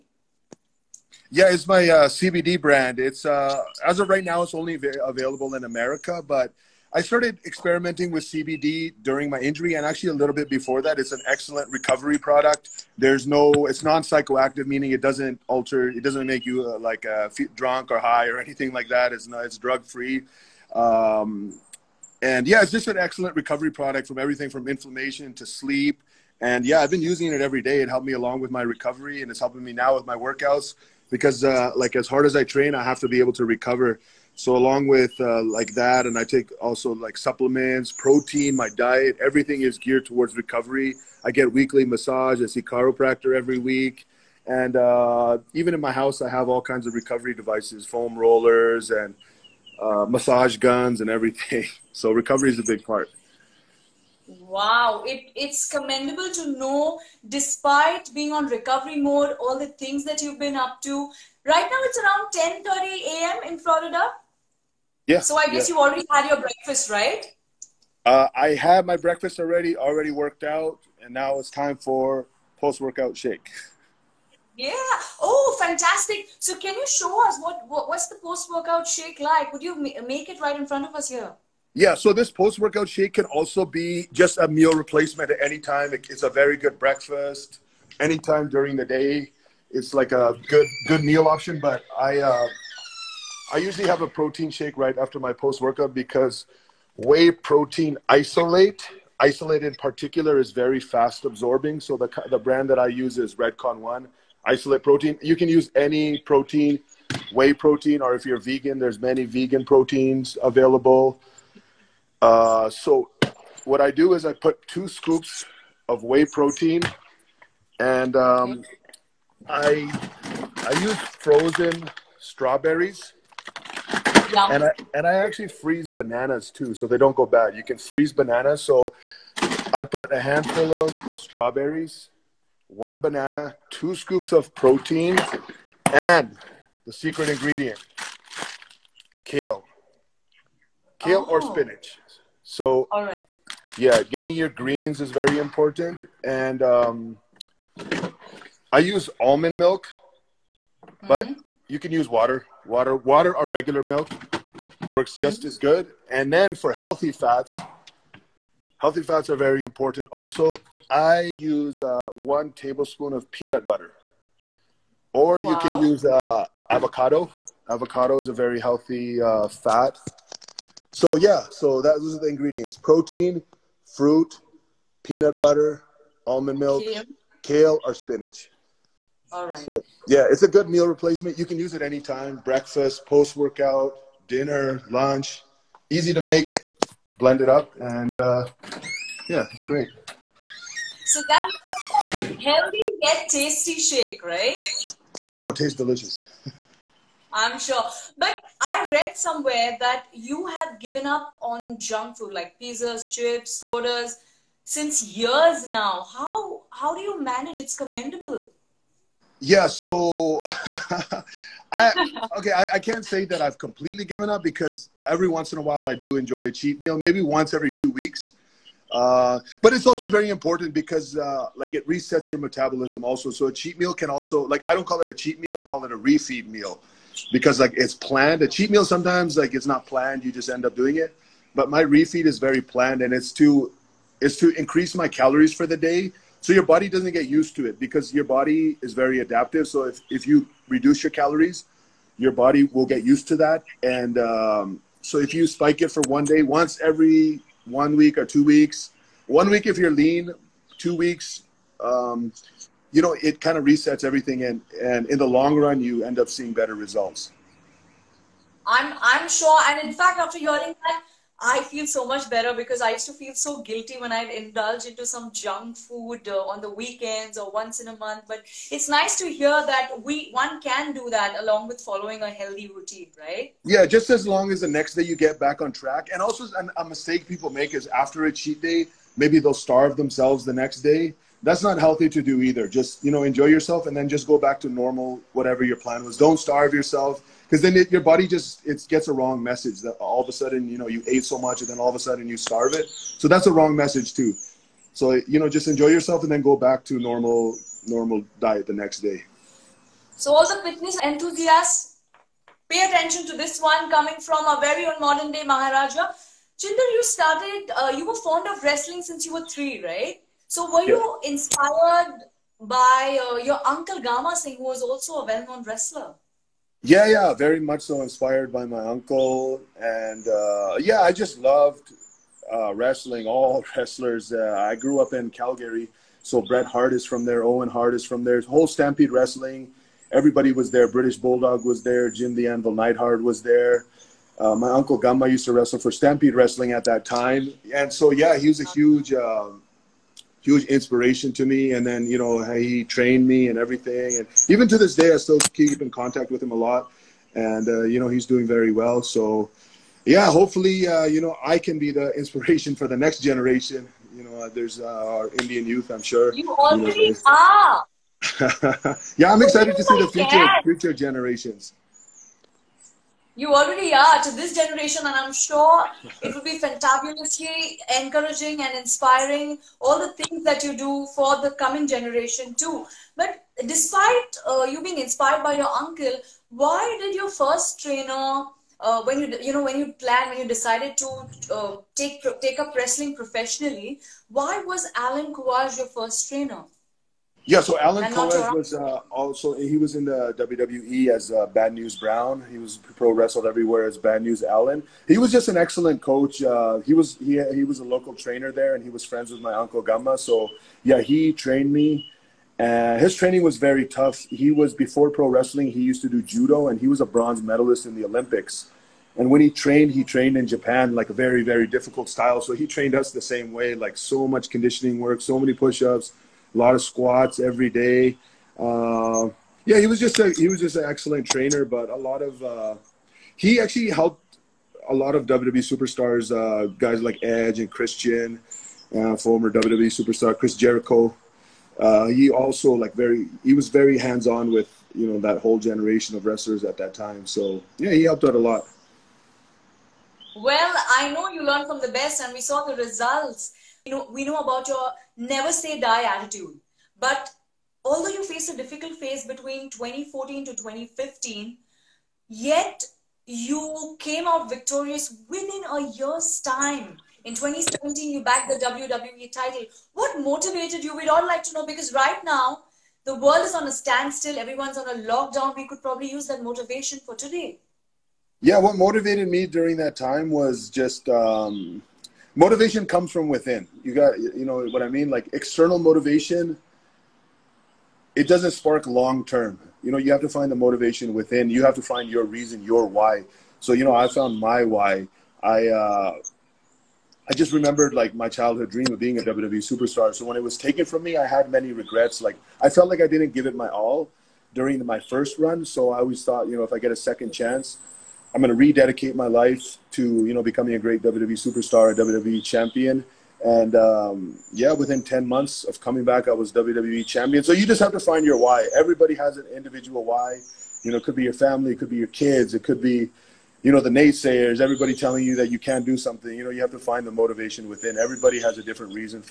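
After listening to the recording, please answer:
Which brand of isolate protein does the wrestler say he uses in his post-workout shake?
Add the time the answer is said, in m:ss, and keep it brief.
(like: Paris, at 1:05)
Redcon One, at 1:43.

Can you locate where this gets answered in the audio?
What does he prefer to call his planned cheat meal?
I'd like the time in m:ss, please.
3:45.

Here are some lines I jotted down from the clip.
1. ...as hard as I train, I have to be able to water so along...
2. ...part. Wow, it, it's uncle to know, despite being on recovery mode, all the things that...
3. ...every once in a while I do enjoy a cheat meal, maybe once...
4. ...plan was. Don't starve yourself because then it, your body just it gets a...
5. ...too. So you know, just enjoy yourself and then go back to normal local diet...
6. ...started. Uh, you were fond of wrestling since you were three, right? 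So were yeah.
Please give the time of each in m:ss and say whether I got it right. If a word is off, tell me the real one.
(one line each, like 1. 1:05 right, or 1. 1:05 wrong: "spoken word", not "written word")
1. 0:31 wrong: "recover", not "water"
2. 0:52 wrong: "commendable", not "uncle"
3. 3:35 right
4. 4:45 right
5. 4:54 wrong: "normal", not "local"
6. 5:07 right.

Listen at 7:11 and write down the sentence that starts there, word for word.
Uh, he also like very he was very hands on with you know that whole generation of wrestlers at that time.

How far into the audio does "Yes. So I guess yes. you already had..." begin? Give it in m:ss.
1:05.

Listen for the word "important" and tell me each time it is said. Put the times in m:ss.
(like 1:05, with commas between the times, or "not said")
2:25, 2:39, 3:40.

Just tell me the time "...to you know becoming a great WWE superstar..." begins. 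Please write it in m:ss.
8:19.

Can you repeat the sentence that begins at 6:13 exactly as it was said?
But despite uh, you being inspired by your uncle, why did your first trainer?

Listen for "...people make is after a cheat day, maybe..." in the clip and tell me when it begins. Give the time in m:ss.
4:37.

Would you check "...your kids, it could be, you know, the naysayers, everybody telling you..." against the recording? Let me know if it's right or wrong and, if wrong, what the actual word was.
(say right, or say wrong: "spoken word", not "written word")
right.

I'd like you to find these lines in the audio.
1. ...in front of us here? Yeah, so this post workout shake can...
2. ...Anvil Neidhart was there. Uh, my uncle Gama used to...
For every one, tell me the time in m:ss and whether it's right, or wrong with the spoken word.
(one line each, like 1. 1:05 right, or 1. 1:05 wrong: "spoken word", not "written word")
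1. 1:20 right
2. 5:32 right.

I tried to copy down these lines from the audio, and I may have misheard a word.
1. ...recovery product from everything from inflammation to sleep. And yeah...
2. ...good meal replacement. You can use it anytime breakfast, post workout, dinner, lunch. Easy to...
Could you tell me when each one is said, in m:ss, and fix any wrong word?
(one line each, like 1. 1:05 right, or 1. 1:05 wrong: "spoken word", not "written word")
1. 0:23 right
2. 3:00 right.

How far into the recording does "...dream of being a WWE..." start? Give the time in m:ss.
8:08.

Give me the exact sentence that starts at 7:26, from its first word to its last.
But although you faced a difficult phase between 2014 to 2015, yet you came out victorious within a year's time.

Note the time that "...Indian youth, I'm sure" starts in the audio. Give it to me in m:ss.
5:55.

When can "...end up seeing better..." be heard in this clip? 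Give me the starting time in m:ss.
4:16.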